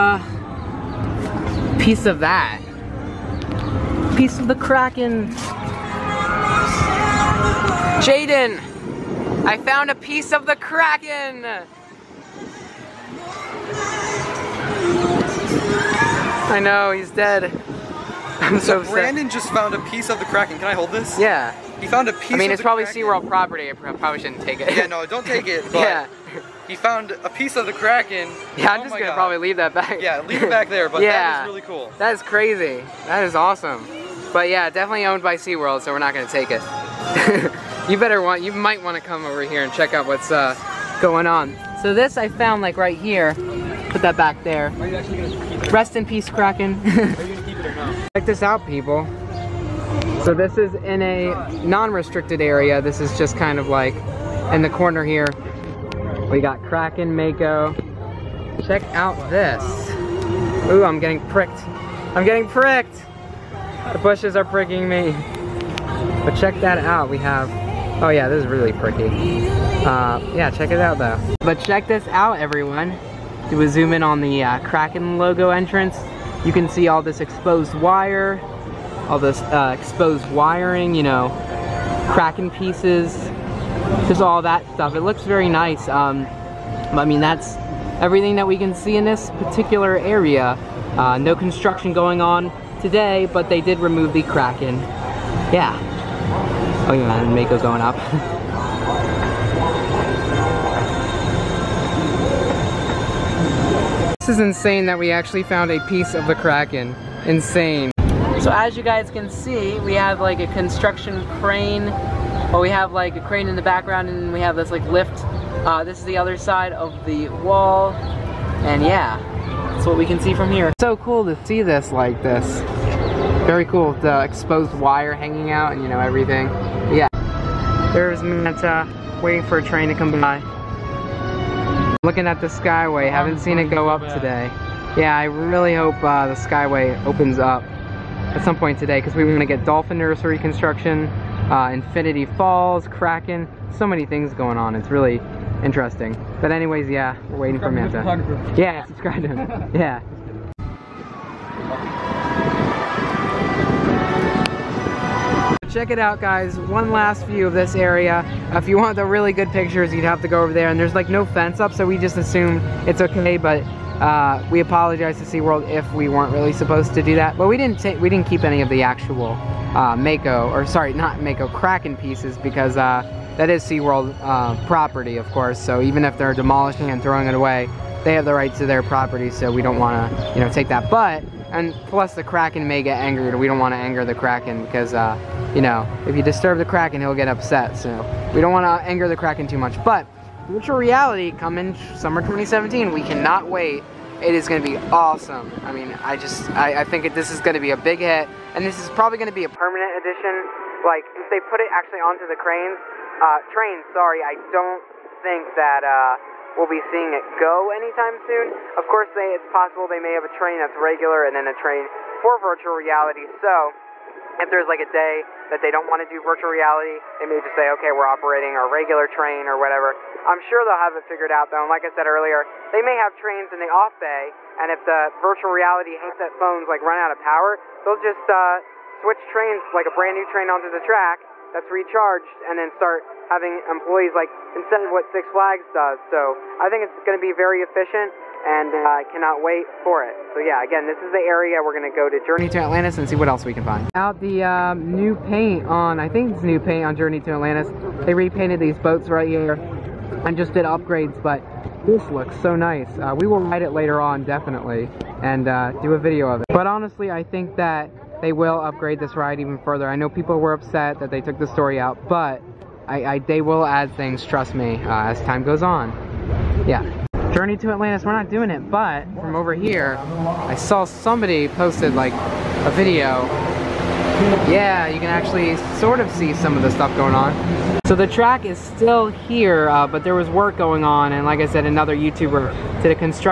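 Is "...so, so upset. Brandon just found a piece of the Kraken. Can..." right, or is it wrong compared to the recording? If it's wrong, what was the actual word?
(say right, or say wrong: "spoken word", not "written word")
right.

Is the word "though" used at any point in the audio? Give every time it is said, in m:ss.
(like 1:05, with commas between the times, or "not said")
1:10, 3:41.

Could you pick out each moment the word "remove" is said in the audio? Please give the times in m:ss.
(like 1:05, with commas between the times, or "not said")
1:33.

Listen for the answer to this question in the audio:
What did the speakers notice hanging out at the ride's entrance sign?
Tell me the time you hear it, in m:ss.
1:19.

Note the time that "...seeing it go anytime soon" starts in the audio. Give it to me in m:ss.
3:26.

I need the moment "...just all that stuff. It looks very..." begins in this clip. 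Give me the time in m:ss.
1:24.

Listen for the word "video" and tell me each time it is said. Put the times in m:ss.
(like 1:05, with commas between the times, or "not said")
4:15, 4:32.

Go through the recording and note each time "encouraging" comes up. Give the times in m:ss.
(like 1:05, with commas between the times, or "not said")
not said.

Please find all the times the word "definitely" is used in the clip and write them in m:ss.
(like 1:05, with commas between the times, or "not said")
0:34, 4:14.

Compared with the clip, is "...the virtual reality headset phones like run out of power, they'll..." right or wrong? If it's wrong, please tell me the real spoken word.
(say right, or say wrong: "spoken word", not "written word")
right.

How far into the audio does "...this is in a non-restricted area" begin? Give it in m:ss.
0:50.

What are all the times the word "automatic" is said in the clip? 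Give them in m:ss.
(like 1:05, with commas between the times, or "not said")
not said.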